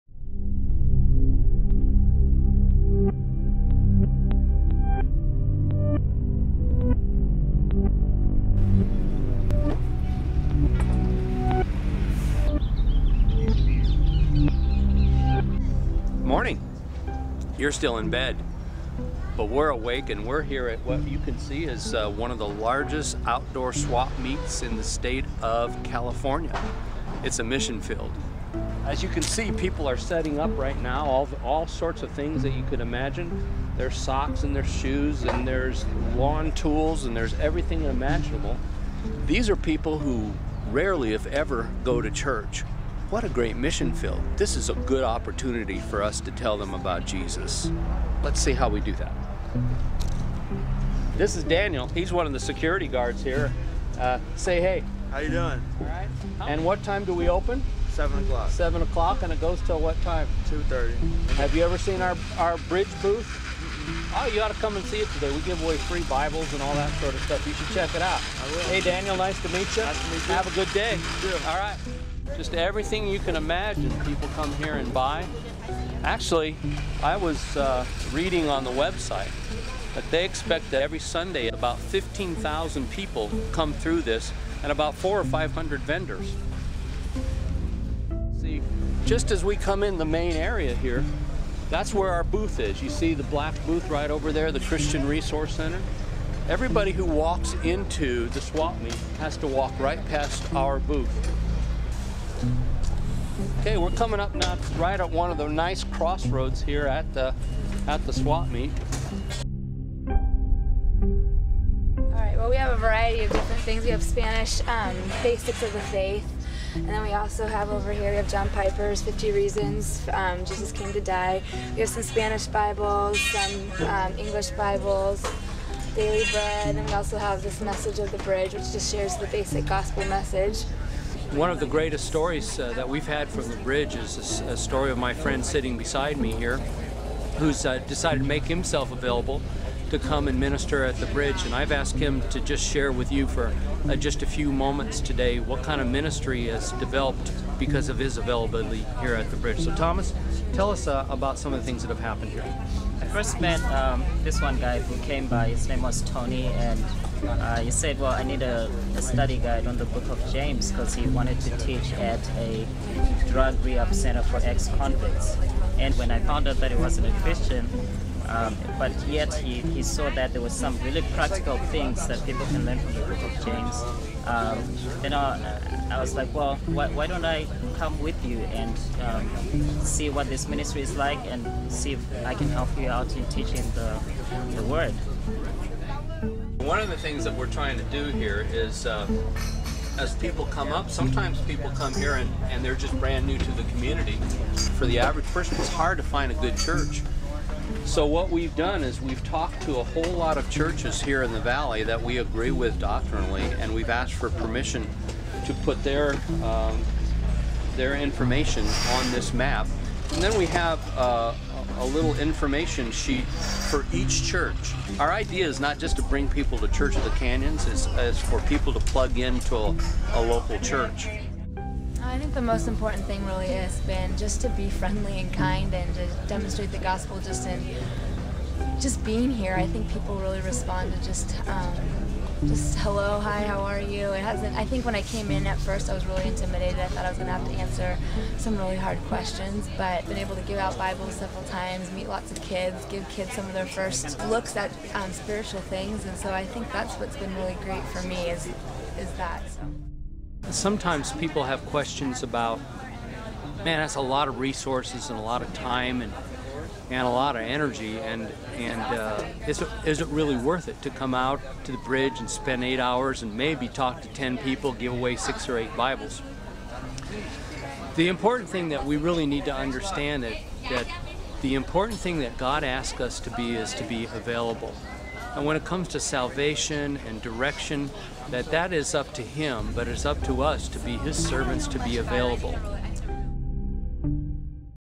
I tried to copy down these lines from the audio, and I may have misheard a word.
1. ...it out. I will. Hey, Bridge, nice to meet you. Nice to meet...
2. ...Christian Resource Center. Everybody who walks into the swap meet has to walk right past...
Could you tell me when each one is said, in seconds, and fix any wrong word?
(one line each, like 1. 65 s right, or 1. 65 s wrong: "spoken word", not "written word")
1. 67 s wrong: "Daniel", not "Bridge"
2. 94 s right.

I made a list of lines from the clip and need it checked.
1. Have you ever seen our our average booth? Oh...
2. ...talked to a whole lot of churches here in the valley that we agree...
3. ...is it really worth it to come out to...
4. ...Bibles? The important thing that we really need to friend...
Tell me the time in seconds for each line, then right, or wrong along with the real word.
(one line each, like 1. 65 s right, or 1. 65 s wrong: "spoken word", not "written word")
1. 61 s wrong: "bridge", not "average"
2. 199 s right
3. 259 s right
4. 265 s wrong: "understand", not "friend".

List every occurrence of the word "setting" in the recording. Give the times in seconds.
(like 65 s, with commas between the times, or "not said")
29 s.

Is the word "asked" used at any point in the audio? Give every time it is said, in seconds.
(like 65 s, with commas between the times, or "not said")
141 s, 203 s.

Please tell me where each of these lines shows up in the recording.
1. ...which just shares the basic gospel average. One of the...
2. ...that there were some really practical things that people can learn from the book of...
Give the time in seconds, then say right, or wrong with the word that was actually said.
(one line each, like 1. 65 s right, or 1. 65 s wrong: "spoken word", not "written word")
1. 128 s wrong: "message", not "average"
2. 170 s right.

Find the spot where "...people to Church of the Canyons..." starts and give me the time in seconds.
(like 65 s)
216 s.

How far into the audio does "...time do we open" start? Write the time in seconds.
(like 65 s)
56 s.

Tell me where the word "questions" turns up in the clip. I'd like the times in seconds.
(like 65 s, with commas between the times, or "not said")
239 s, 251 s.